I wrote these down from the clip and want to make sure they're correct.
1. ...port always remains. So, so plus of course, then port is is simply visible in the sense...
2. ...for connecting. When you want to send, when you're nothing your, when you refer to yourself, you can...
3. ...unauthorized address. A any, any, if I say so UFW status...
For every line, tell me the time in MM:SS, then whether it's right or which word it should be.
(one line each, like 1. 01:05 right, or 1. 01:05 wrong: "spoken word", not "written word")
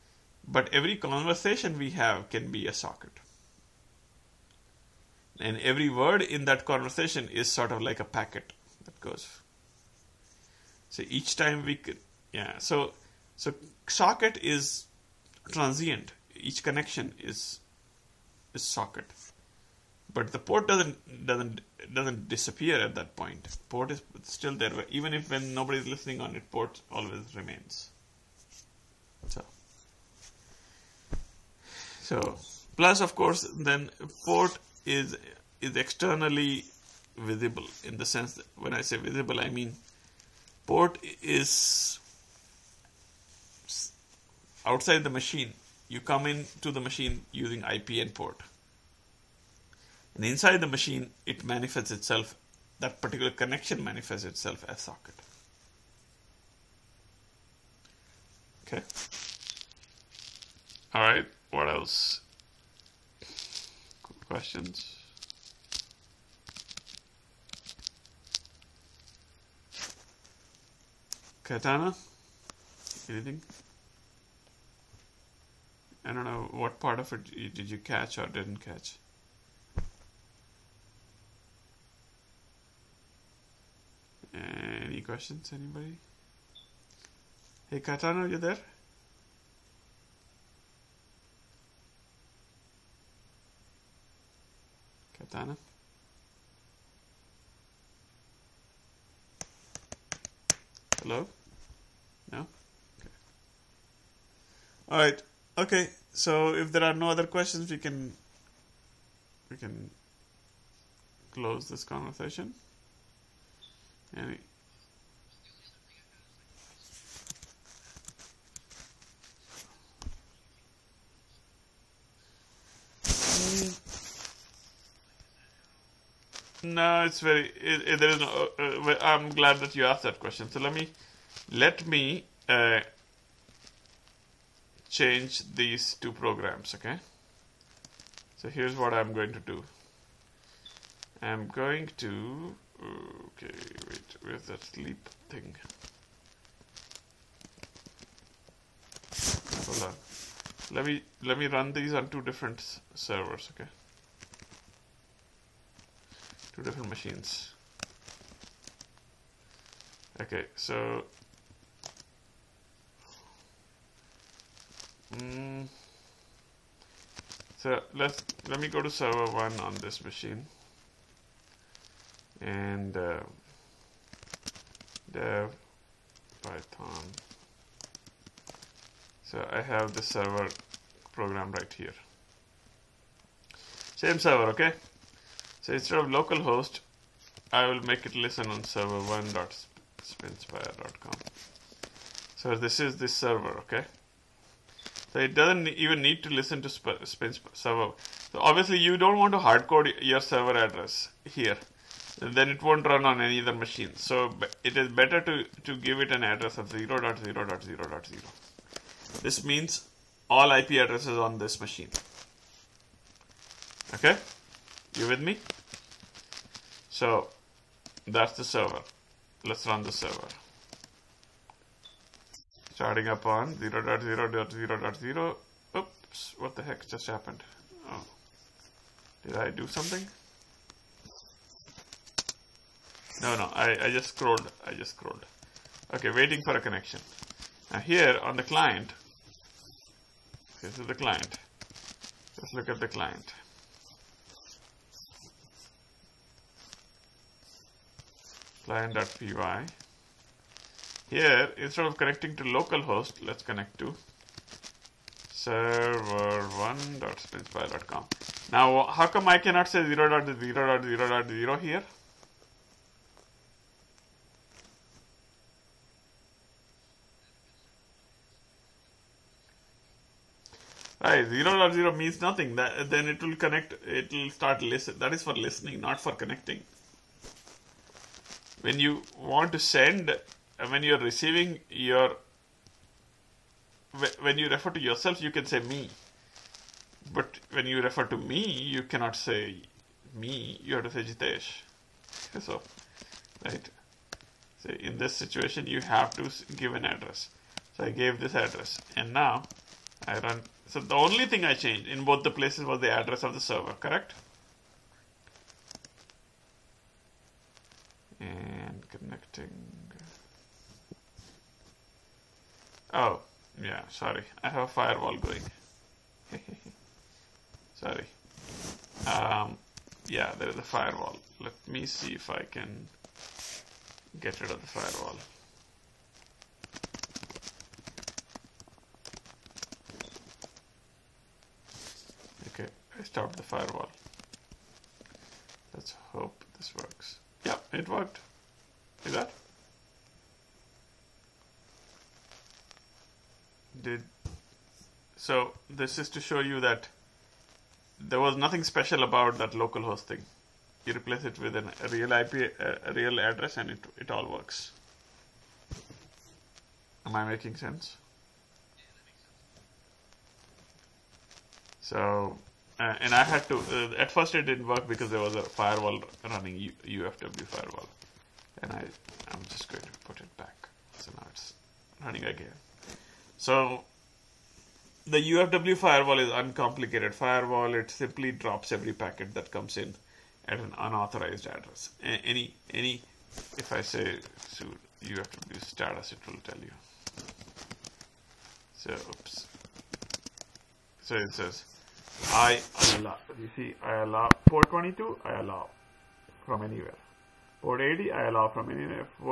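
1. 00:26 wrong: "externally", not "simply"
2. 04:35 wrong: "receiving", not "nothing"
3. 06:20 right.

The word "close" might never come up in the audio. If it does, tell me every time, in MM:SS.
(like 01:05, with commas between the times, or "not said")
01:51.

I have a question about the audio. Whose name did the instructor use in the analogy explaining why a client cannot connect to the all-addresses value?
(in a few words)
Jitesh.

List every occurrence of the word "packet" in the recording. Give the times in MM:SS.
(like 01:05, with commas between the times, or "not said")
00:08, 06:18.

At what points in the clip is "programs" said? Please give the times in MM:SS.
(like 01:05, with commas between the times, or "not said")
02:16, 03:01.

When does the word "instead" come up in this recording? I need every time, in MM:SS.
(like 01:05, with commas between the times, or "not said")
03:05, 04:11.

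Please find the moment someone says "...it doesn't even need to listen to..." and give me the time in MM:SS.
03:15.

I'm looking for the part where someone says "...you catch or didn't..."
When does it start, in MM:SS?
01:17.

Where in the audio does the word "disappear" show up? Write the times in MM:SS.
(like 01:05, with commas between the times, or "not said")
00:22.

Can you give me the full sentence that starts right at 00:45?
You come in to the machine using IP and port.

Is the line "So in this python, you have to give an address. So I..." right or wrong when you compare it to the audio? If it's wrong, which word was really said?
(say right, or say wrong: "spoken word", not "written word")
wrong: "situation", not "python".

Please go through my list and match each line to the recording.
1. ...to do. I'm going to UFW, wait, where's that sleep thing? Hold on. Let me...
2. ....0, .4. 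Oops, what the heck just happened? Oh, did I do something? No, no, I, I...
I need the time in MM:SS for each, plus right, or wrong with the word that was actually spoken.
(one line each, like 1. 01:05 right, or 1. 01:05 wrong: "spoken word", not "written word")
1. 02:19 wrong: "Okay", not "UFW"
2. 03:43 wrong: "0", not "4".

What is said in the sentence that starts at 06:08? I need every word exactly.
And I, I'm just going to put it back.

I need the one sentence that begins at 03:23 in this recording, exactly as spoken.
So it is better to, to give it an address of 0, .0, .0, .0.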